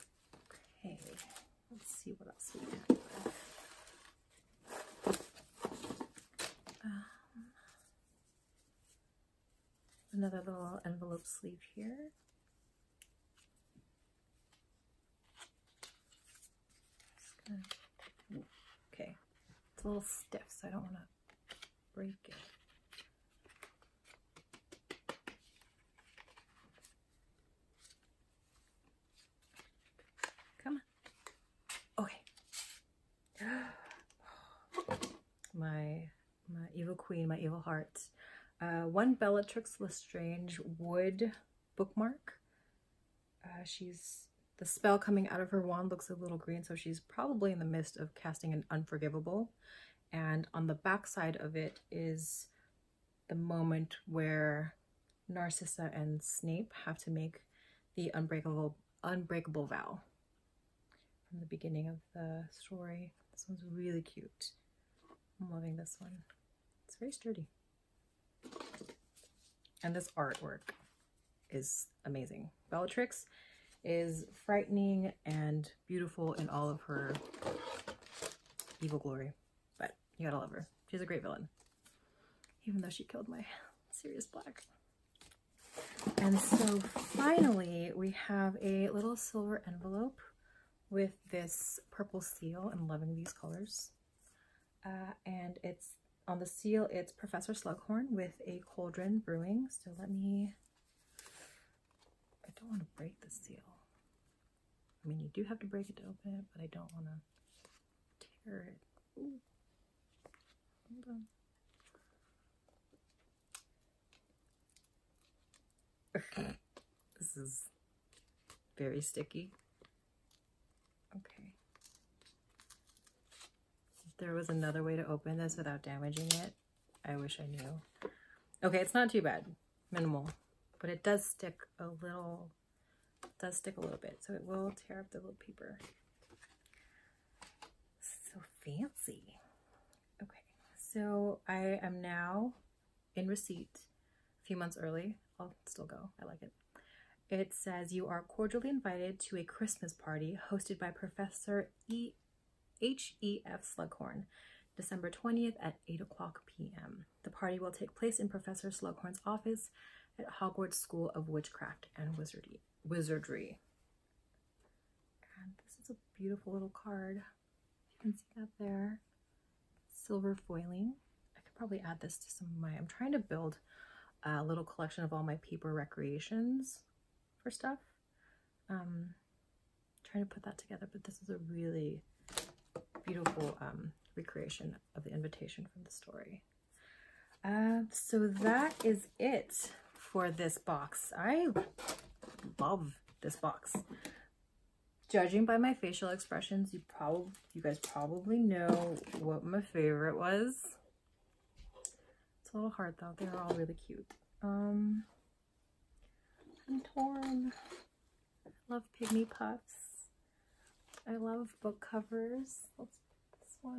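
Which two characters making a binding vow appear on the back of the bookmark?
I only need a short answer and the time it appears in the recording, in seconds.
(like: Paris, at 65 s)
Narcissa and Snape, at 55 s.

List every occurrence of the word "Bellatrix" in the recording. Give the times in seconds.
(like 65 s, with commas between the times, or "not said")
39 s, 72 s.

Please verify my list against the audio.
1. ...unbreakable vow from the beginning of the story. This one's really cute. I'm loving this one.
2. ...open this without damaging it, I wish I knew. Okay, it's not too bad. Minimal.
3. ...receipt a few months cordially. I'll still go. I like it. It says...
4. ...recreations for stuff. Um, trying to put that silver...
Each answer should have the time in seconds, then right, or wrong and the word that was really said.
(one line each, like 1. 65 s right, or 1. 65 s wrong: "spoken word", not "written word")
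1. 59 s right
2. 125 s right
3. 143 s wrong: "early", not "cordially"
4. 175 s wrong: "together", not "silver".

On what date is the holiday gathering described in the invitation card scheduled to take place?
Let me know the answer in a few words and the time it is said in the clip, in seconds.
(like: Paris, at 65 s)
December 20th, at 154 s.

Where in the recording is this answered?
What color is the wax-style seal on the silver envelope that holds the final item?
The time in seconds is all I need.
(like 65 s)
91 s.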